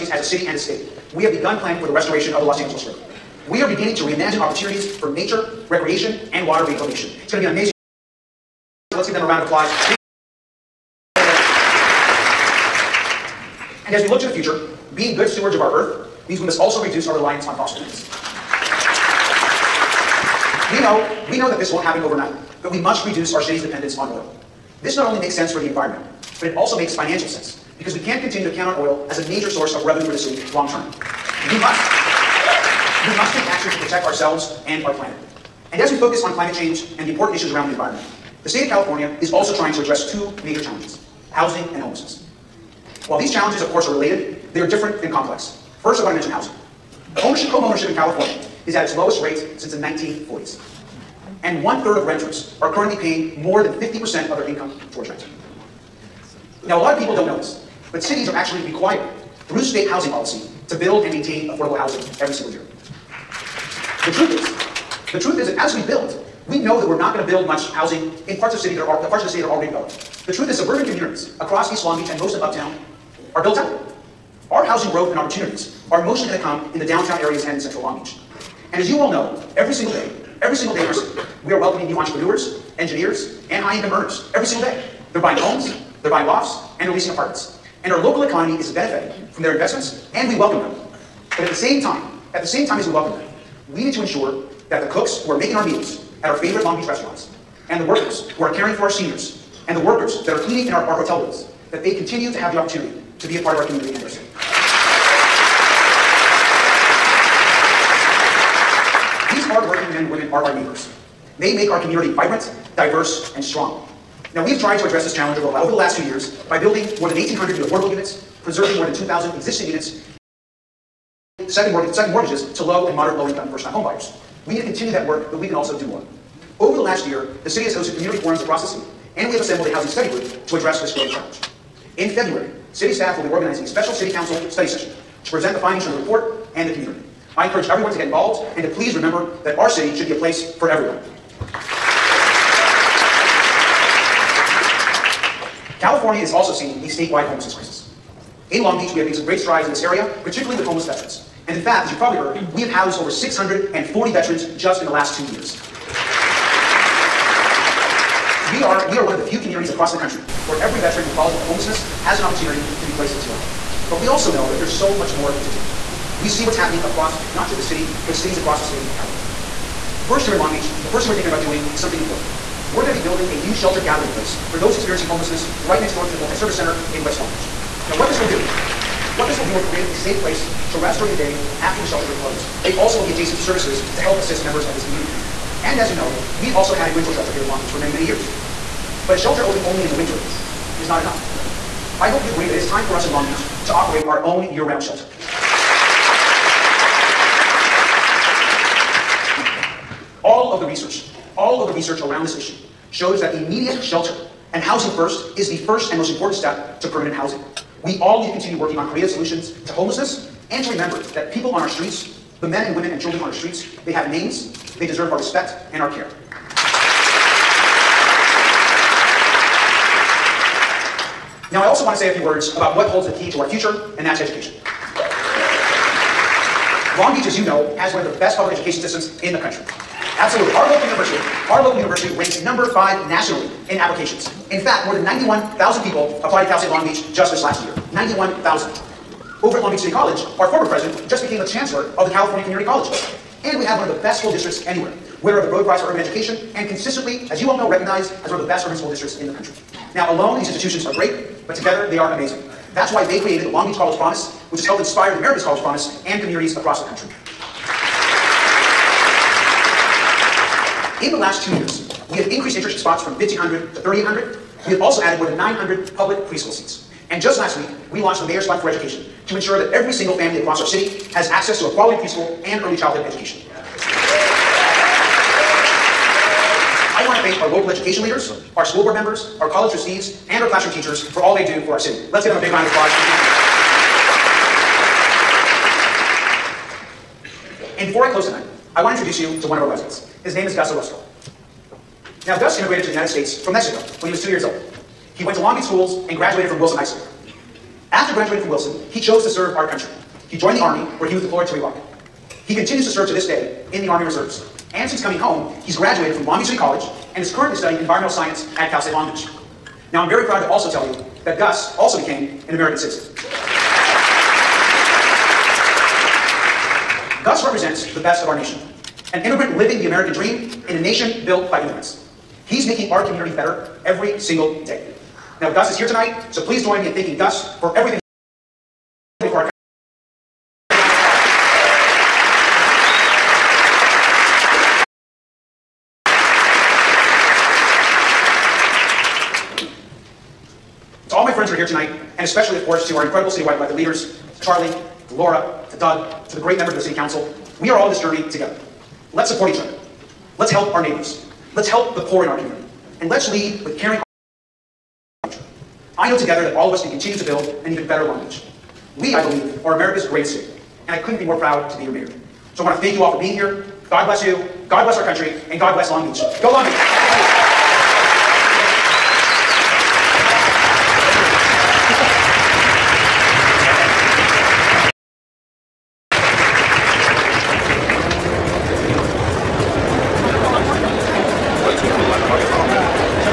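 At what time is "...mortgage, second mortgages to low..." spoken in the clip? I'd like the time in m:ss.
2:01.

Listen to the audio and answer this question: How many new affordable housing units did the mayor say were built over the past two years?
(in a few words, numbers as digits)
1,800.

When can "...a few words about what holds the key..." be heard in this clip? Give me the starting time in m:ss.
3:42.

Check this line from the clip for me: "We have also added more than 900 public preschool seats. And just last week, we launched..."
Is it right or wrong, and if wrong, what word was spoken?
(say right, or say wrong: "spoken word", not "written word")
right.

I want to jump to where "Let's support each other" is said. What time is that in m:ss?
5:49.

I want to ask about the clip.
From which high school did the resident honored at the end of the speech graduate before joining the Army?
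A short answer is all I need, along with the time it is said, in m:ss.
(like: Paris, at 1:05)
Wilson High School, at 4:56.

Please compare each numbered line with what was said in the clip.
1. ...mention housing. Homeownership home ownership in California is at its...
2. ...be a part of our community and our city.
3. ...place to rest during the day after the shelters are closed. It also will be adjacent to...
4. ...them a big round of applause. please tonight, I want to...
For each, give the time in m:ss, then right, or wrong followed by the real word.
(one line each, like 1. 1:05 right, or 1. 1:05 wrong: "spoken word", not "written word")
1. 0:46 right
2. 1:43 right
3. 3:00 right
4. 4:42 wrong: "close", not "please".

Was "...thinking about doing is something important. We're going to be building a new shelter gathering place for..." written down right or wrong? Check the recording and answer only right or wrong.
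right.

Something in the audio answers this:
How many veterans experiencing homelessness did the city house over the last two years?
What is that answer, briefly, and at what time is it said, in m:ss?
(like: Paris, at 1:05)
640, at 2:33.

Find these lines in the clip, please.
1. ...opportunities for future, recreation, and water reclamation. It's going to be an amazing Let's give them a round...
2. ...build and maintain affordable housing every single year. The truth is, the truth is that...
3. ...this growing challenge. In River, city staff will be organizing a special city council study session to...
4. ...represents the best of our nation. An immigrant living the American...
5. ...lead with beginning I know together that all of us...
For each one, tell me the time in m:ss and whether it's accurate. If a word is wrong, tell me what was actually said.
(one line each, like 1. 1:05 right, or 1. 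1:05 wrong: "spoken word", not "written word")
1. 0:04 wrong: "nature", not "future"
2. 1:00 right
3. 2:10 wrong: "February", not "River"
4. 5:17 right
5. 5:53 wrong: "caring", not "beginning".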